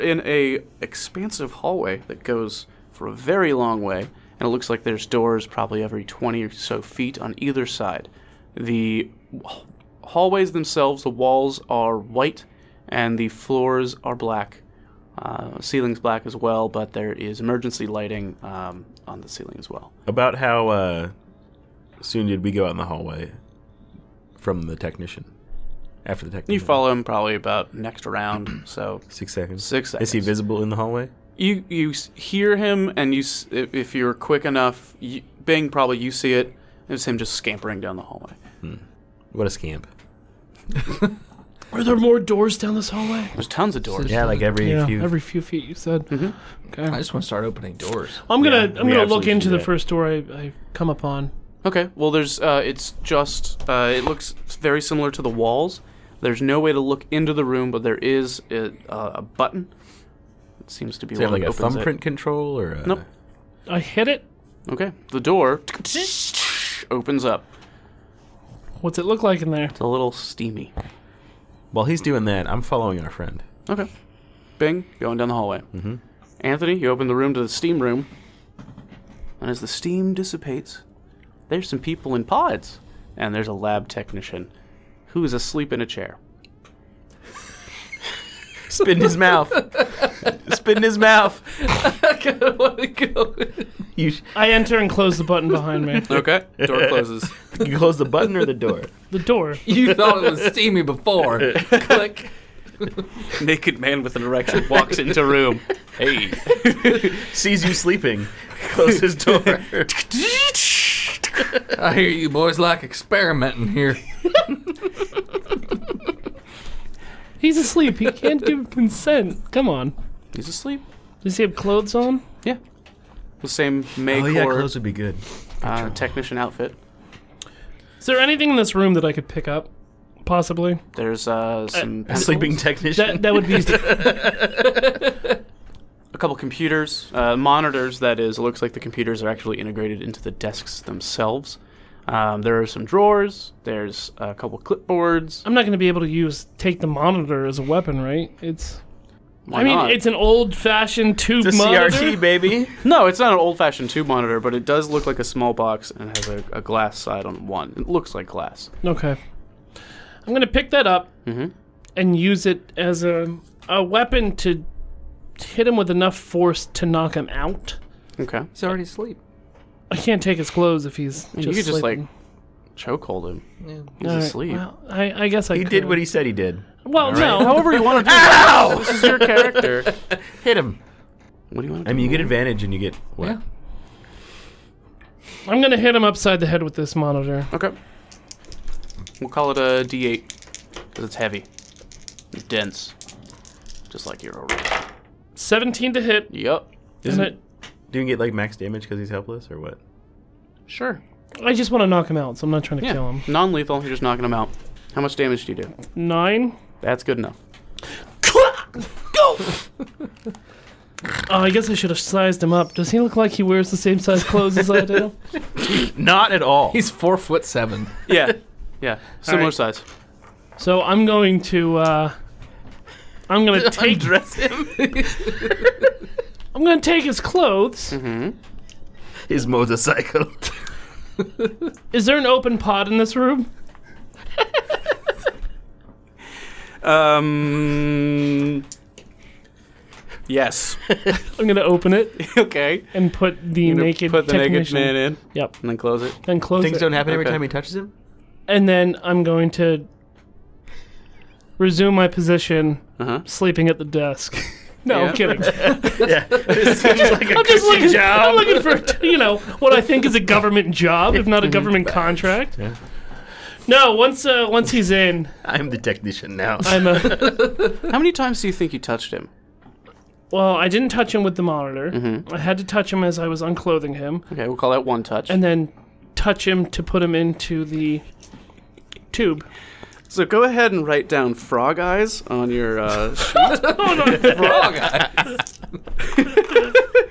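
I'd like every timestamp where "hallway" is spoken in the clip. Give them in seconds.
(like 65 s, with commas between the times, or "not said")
1 s, 10 s, 22 s, 30 s, 38 s, 42 s, 75 s.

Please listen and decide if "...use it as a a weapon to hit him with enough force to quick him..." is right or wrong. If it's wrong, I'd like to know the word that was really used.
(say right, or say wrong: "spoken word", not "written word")
wrong: "knock", not "quick".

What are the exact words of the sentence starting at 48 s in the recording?
I'm gonna yeah, I'm gonna look into the first door I, I, come upon.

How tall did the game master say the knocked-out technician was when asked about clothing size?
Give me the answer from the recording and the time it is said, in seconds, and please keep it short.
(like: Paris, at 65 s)
4 foot 7, at 216 s.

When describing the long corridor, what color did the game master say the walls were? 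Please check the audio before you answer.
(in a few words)
White.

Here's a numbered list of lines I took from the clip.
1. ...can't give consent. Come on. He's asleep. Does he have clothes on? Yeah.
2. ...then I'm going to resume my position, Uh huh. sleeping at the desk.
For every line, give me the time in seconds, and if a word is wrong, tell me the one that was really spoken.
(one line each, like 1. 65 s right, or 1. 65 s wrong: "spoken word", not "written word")
1. 118 s right
2. 248 s right.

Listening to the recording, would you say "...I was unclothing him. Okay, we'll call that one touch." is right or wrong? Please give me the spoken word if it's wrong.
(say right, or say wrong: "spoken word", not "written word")
right.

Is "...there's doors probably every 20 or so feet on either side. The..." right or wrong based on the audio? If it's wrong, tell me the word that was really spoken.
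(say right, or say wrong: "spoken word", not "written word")
right.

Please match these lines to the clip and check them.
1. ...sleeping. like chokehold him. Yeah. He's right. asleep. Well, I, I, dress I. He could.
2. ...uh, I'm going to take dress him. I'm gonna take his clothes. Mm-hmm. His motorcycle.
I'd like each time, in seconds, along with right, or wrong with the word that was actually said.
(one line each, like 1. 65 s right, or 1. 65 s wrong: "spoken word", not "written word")
1. 171 s wrong: "guess", not "dress"
2. 221 s right.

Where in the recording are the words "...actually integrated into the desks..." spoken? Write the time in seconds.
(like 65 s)
139 s.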